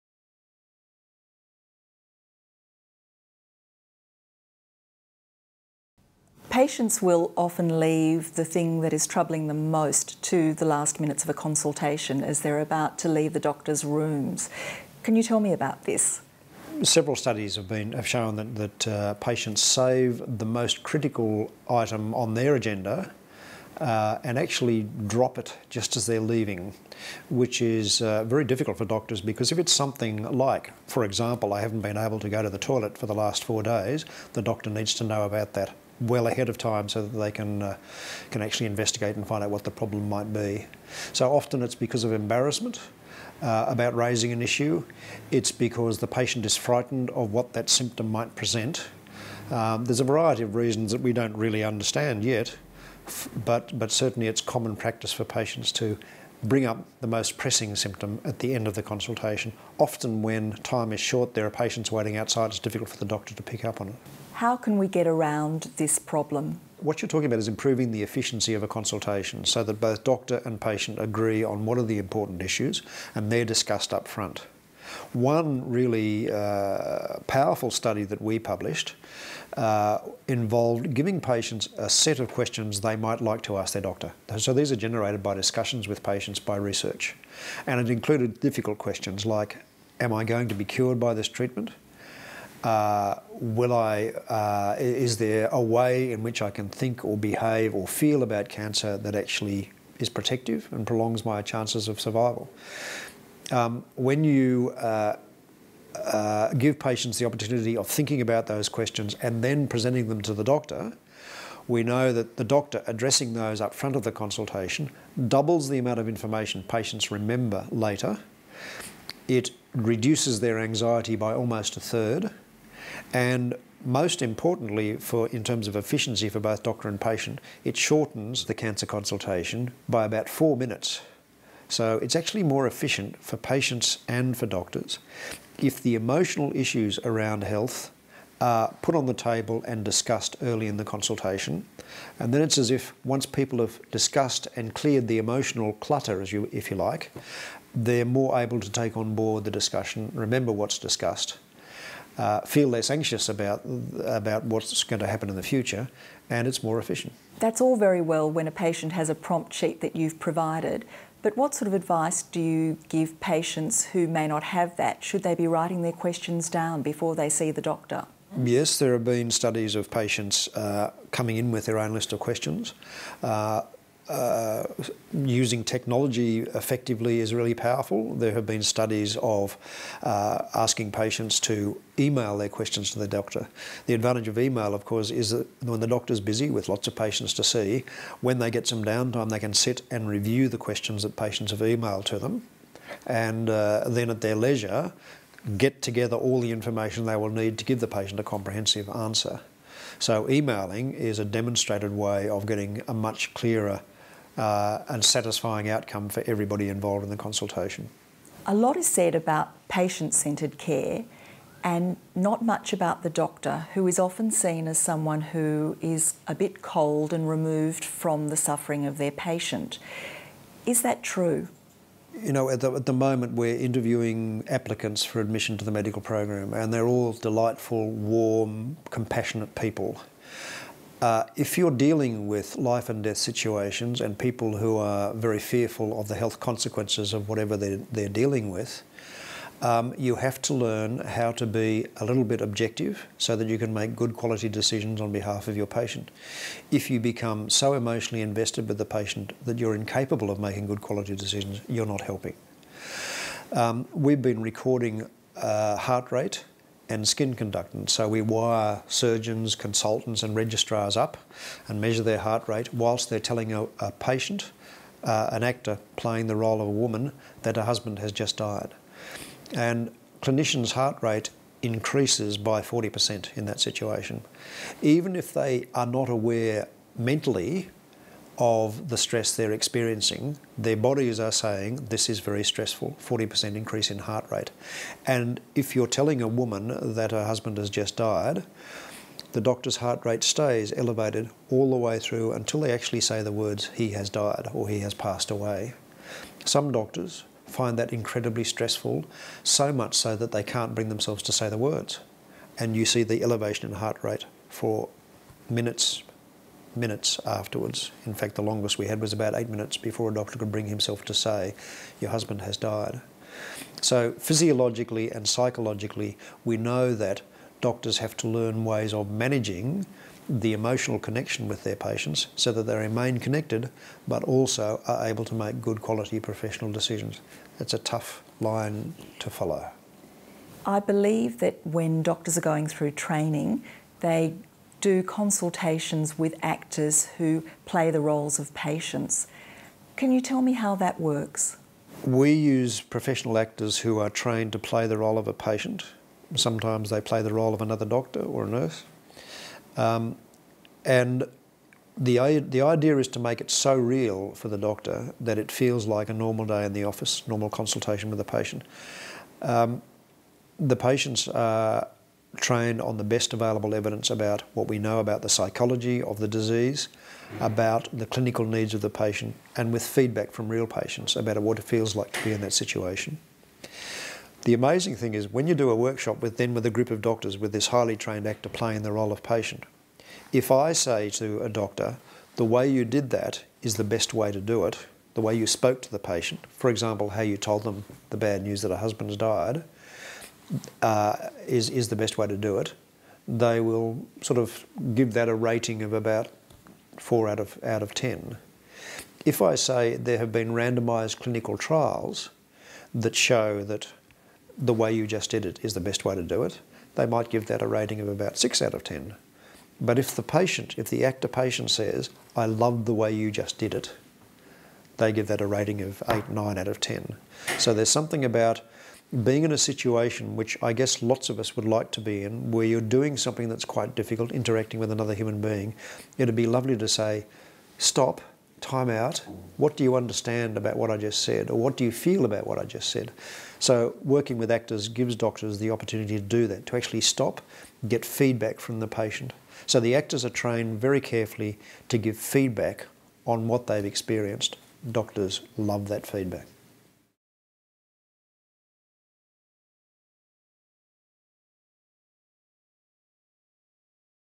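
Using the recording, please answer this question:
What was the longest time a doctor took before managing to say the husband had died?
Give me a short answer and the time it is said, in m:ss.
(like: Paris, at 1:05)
about 8 minutes, at 5:09.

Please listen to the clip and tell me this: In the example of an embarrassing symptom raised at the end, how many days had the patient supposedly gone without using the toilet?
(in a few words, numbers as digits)
4.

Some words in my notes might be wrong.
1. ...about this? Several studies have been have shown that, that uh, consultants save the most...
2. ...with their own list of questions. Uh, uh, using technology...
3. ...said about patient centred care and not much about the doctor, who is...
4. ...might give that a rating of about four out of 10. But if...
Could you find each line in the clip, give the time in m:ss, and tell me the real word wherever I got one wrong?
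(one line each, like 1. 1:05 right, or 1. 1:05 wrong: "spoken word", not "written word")
1. 0:15 wrong: "patients", not "consultants"
2. 2:51 right
3. 3:28 right
4. 6:47 wrong: "six", not "four".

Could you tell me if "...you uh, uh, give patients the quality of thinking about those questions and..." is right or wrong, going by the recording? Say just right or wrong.
wrong.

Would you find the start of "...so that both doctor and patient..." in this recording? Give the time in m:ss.
1:09.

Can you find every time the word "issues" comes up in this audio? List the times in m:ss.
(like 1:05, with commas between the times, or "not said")
0:44, 1:12, 2:16.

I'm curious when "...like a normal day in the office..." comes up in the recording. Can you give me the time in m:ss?
5:55.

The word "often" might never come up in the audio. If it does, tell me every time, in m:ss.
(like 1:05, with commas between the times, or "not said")
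0:07, 0:41, 0:59, 3:33.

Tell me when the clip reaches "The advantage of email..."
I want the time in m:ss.
3:03.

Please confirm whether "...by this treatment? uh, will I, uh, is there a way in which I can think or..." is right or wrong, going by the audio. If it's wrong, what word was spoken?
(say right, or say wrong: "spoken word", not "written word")
right.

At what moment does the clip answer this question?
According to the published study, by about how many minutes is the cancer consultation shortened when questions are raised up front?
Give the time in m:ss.
2:10.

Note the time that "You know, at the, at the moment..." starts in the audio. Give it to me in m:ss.
3:42.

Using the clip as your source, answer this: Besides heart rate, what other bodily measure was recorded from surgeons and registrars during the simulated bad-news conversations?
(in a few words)
skin conductance.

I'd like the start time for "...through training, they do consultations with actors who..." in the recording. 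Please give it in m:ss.
5:32.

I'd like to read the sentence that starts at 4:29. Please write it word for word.
And clinicians' heart rate increases by 40% in that situation.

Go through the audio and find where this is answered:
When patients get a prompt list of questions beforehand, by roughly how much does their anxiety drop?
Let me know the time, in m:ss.
2:01.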